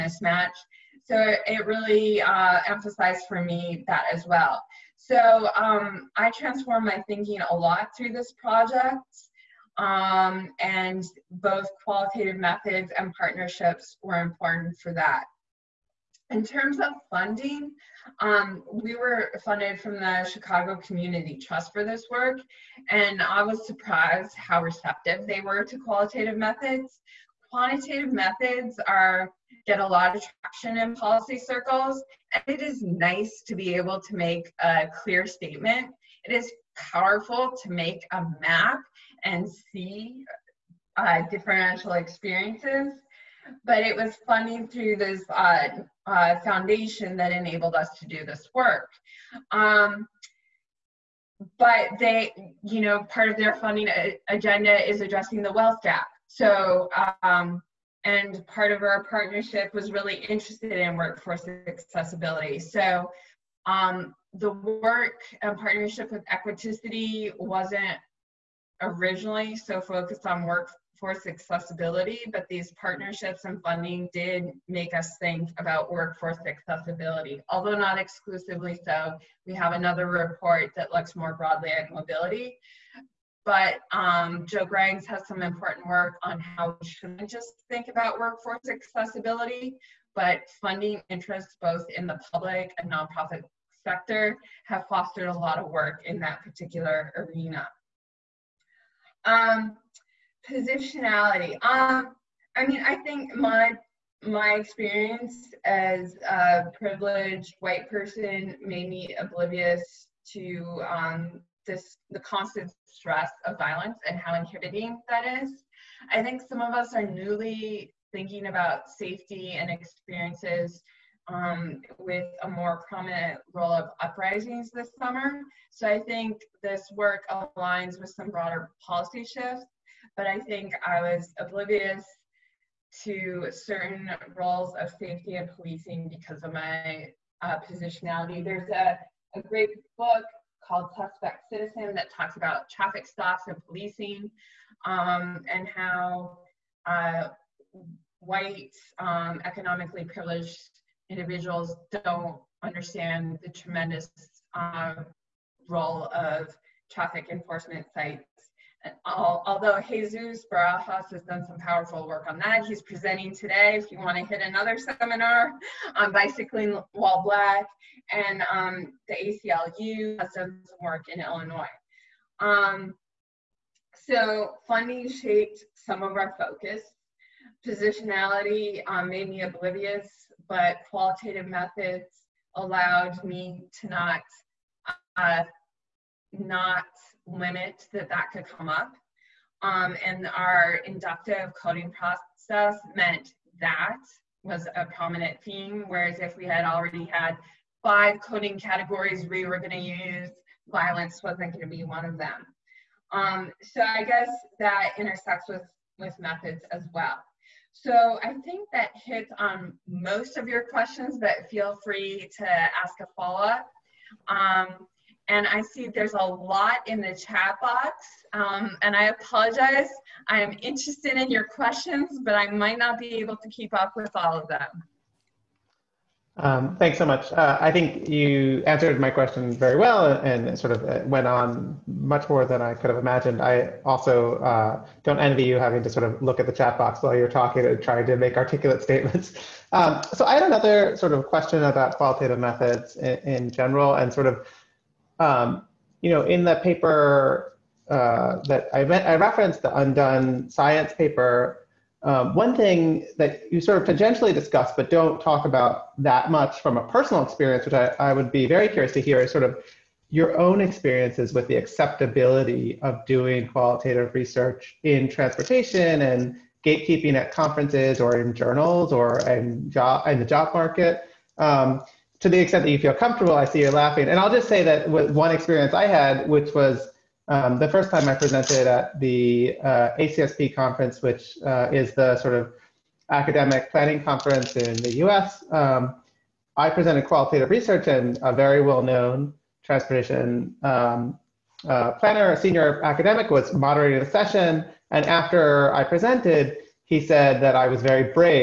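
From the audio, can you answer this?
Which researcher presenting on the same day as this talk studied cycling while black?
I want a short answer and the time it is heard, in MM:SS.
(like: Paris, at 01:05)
Jesus Barajas, at 02:39.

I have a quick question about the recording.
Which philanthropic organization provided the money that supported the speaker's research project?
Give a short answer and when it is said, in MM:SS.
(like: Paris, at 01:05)
Chicago Community Trust, at 00:20.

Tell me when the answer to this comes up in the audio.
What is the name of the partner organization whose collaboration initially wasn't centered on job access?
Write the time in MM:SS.
01:06.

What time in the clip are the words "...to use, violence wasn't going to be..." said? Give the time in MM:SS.
03:19.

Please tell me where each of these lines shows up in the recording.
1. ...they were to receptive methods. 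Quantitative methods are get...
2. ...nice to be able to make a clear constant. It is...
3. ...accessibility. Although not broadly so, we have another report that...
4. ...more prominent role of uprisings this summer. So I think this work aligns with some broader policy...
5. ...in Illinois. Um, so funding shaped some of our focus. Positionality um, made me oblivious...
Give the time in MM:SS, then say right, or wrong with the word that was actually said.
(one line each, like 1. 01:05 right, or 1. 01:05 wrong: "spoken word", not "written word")
1. 00:25 wrong: "qualitative", not "receptive"
2. 00:32 wrong: "statement", not "constant"
3. 01:16 wrong: "exclusively", not "broadly"
4. 02:02 right
5. 02:51 right.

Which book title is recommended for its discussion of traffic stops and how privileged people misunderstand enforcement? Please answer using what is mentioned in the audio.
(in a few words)
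Suspect Citizen.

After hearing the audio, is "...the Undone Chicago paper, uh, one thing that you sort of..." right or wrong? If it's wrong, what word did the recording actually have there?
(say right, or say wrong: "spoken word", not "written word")
wrong: "Science", not "Chicago".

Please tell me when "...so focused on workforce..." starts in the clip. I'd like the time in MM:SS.
01:09.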